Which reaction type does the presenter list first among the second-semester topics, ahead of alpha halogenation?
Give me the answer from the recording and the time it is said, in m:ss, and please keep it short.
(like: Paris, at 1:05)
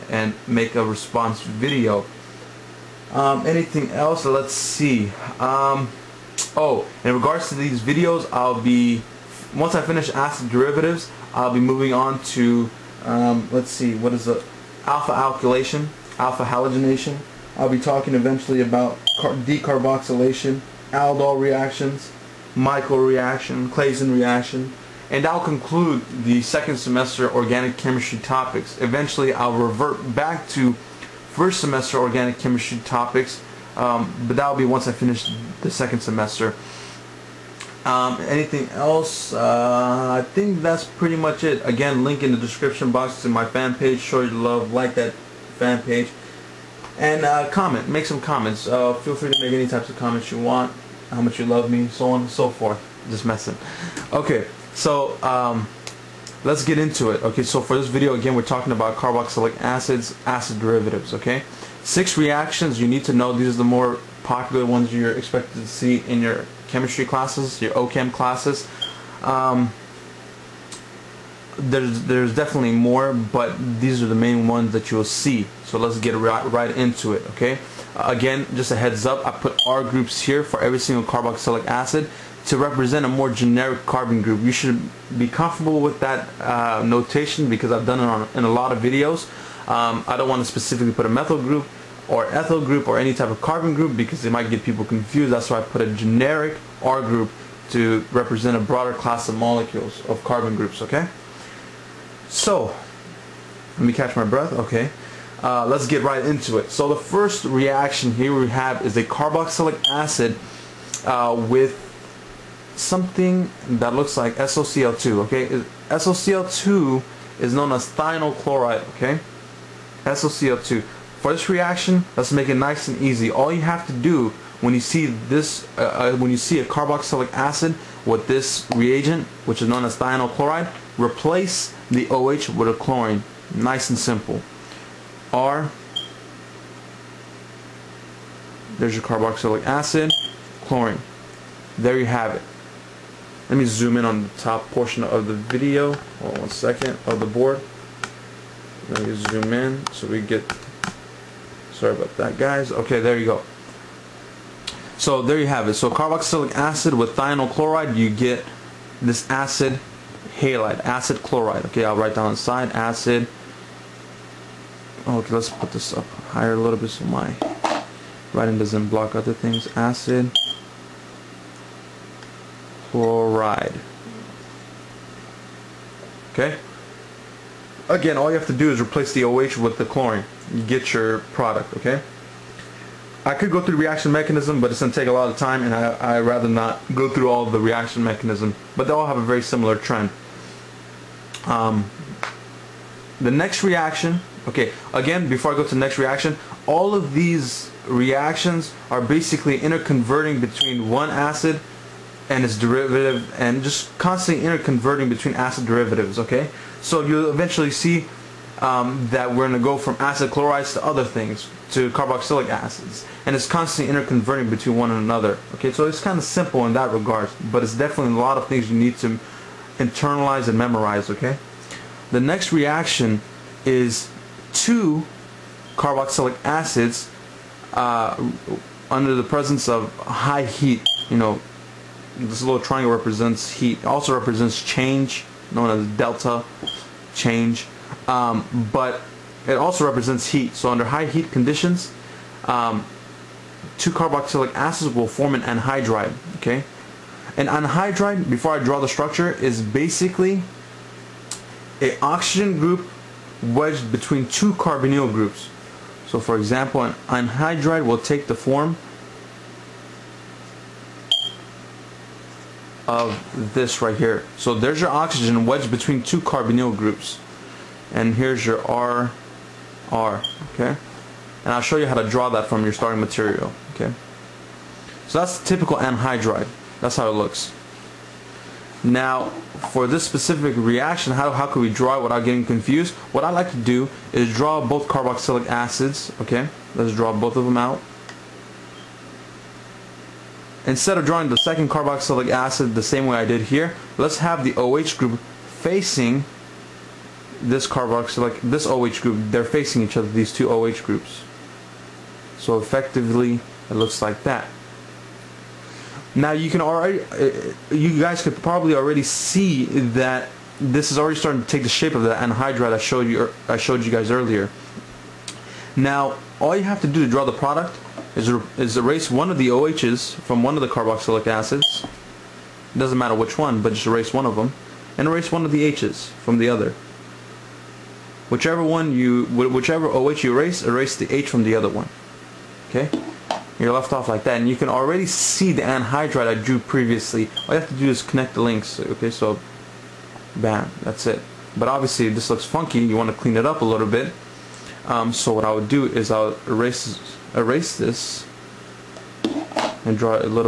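Alpha alkylation, at 0:14.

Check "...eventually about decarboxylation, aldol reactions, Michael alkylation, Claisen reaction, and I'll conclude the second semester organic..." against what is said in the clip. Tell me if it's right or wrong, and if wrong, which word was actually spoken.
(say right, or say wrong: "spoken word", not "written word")
wrong: "reaction", not "alkylation".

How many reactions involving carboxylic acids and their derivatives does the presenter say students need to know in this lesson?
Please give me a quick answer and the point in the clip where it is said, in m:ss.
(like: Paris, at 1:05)
6, at 1:01.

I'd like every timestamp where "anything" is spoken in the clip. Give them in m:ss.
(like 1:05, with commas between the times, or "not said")
0:03, 0:38.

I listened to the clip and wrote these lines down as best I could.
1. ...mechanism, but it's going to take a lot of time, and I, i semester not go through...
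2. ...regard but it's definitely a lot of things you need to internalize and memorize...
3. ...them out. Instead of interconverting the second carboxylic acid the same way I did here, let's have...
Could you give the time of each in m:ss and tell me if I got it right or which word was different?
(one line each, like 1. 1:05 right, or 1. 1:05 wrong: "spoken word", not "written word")
1. 3:04 wrong: "rather", not "semester"
2. 3:36 right
3. 4:47 wrong: "drawing", not "interconverting".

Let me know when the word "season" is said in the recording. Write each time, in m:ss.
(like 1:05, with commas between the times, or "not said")
not said.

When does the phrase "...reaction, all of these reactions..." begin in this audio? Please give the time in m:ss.
3:15.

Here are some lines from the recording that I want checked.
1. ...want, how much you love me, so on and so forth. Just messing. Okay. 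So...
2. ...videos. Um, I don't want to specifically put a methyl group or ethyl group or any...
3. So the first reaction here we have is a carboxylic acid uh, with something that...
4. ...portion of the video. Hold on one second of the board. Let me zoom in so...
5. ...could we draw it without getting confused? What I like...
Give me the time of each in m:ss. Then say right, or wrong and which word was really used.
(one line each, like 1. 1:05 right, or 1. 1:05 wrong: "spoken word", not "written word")
1. 0:50 right
2. 1:28 right
3. 1:46 right
4. 2:24 right
5. 4:41 right.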